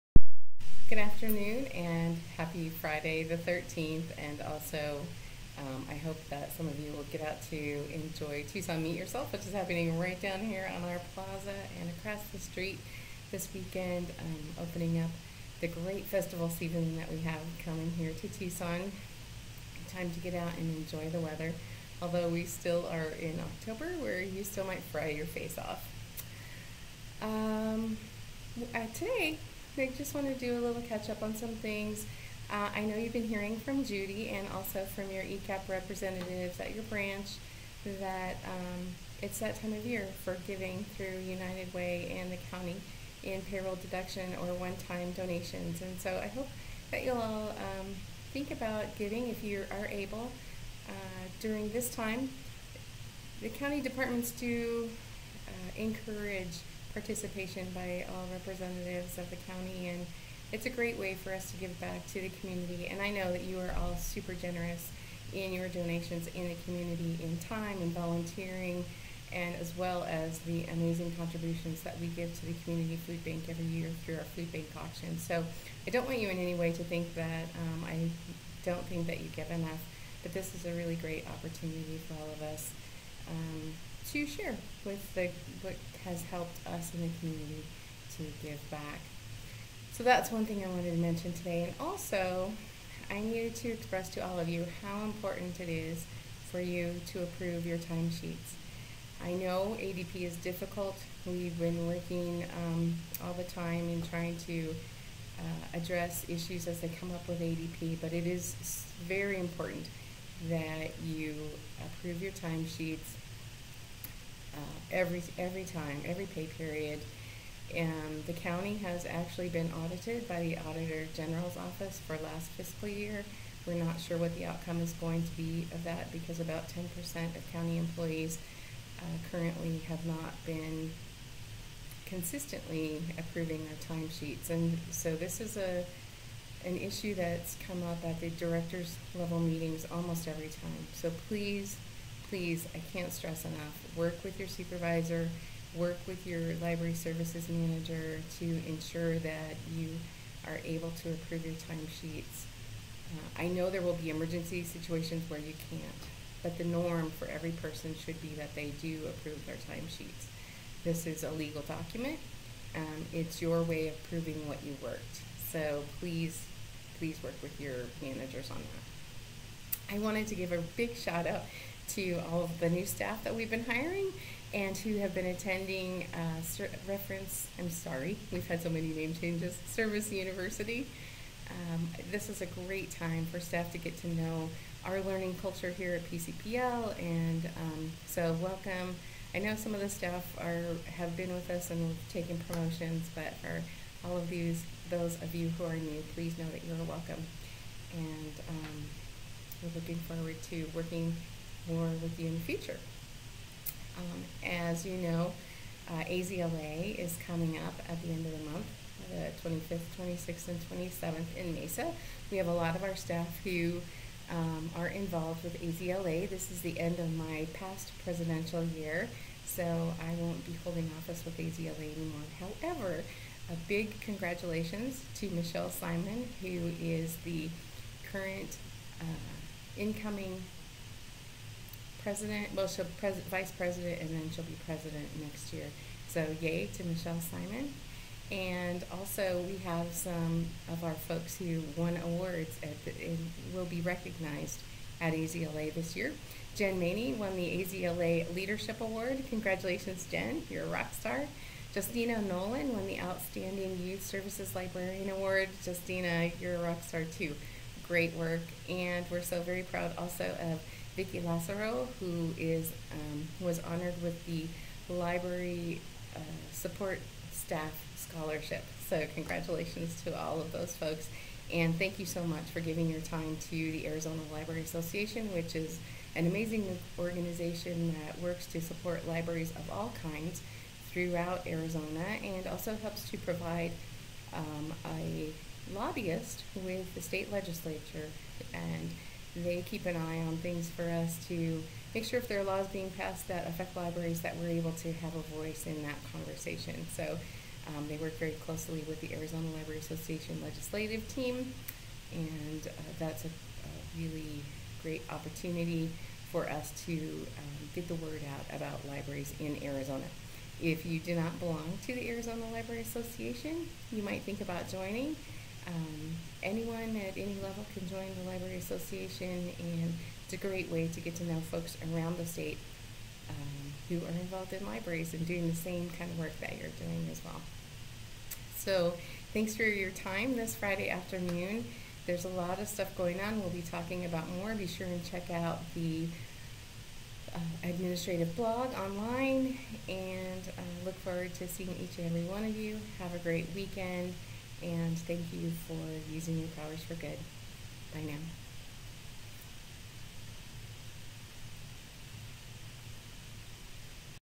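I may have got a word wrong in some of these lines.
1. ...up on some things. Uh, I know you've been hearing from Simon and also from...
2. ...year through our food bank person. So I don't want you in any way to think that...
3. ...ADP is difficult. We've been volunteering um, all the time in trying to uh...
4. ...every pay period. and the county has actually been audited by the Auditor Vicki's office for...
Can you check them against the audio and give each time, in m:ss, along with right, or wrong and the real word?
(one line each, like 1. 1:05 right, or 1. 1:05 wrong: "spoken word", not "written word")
1. 0:31 wrong: "Judy", not "Simon"
2. 1:13 wrong: "auction", not "person"
3. 1:39 wrong: "working", not "volunteering"
4. 1:56 wrong: "General", not "Vicki".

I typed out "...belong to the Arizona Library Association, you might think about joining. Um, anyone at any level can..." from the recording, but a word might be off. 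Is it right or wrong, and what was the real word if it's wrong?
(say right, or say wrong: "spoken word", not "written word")
right.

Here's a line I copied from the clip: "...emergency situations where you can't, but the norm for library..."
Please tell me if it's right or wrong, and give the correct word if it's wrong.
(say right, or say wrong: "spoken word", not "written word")
wrong: "every", not "library".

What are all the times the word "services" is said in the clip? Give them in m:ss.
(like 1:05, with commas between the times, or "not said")
2:26, 2:59, 4:14.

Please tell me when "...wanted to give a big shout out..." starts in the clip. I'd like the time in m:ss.
2:49.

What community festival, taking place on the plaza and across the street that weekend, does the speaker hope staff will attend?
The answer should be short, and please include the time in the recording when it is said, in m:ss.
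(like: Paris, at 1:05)
Tucson Meet Yourself, at 0:08.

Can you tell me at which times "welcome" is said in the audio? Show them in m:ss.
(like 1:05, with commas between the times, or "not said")
3:08, 3:16.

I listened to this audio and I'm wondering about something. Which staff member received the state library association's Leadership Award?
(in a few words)
Jen Maney.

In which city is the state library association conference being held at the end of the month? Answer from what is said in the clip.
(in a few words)
Mesa.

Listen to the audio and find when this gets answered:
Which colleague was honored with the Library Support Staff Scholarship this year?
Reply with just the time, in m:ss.
4:20.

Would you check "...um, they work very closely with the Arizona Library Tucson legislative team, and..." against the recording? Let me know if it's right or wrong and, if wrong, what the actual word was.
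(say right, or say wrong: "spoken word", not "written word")
wrong: "Association", not "Tucson".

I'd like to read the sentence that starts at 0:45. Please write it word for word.
And so I hope that you'll all um, think about giving if you are able uh, during this time.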